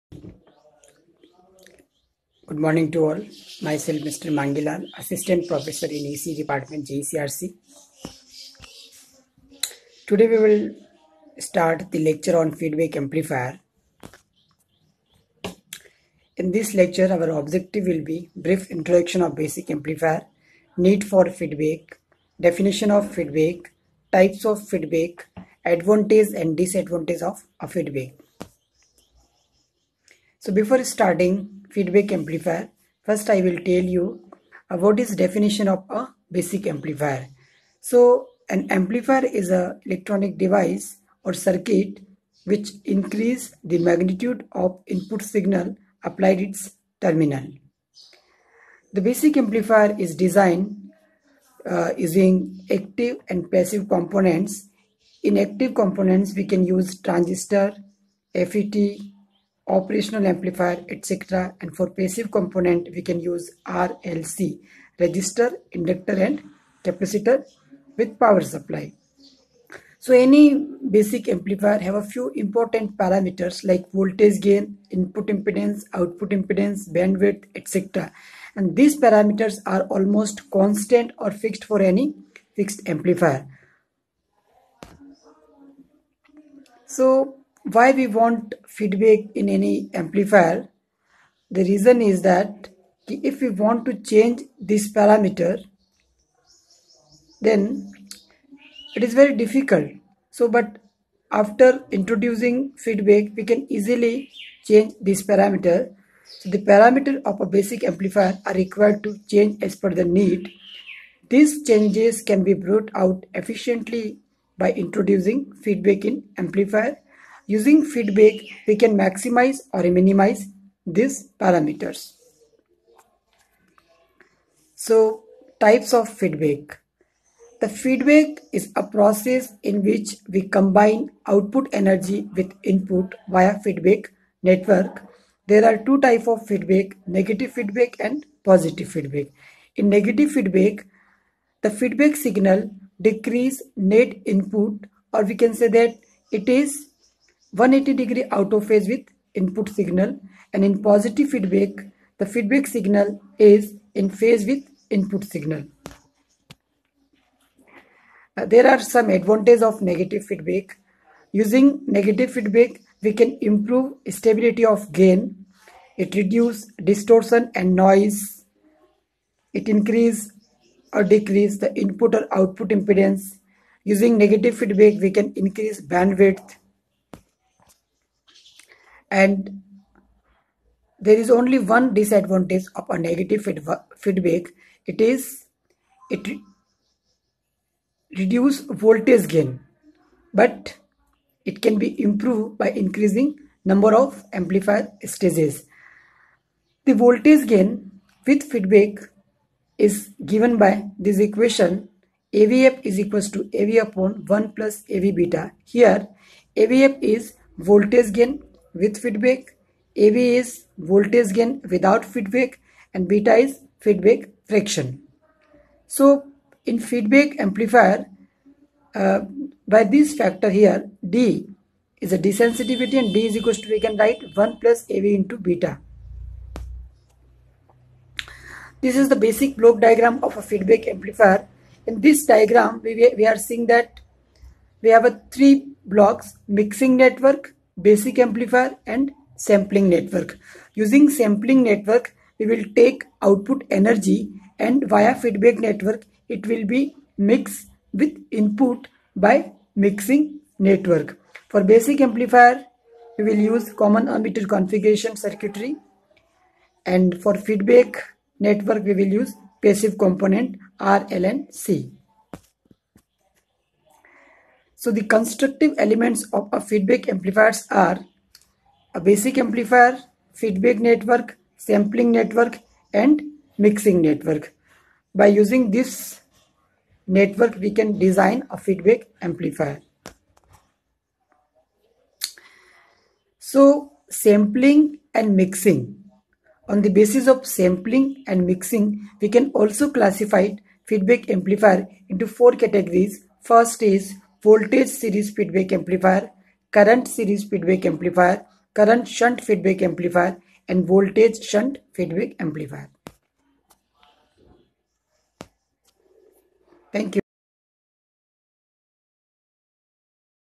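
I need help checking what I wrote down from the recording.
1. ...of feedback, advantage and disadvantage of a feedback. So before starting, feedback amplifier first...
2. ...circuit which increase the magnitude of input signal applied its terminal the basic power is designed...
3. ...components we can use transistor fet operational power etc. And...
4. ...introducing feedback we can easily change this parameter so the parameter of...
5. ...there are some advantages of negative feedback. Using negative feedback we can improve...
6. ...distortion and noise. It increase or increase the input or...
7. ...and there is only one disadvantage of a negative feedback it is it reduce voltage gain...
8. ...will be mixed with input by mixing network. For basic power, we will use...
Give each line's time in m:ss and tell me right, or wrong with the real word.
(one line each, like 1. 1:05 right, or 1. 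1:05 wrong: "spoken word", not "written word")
1. 0:24 right
2. 0:41 wrong: "amplifier", not "power"
3. 0:55 wrong: "amplifier", not "power"
4. 1:41 right
5. 2:38 right
6. 2:46 wrong: "decrease", not "increase"
7. 2:59 right
8. 4:06 wrong: "amplifier", not "power".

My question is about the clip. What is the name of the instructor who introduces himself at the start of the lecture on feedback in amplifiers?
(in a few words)
Mangilal.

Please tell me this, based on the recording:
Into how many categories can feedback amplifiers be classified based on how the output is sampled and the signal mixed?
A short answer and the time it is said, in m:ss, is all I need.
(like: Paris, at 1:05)
4, at 4:52.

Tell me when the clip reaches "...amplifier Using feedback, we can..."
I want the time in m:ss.
1:56.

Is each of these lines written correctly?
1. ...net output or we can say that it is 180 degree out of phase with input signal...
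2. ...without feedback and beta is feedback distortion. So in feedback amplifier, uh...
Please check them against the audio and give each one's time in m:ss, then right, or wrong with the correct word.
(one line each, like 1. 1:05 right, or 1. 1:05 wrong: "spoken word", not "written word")
1. 2:23 wrong: "input", not "output"
2. 3:31 wrong: "fraction", not "distortion".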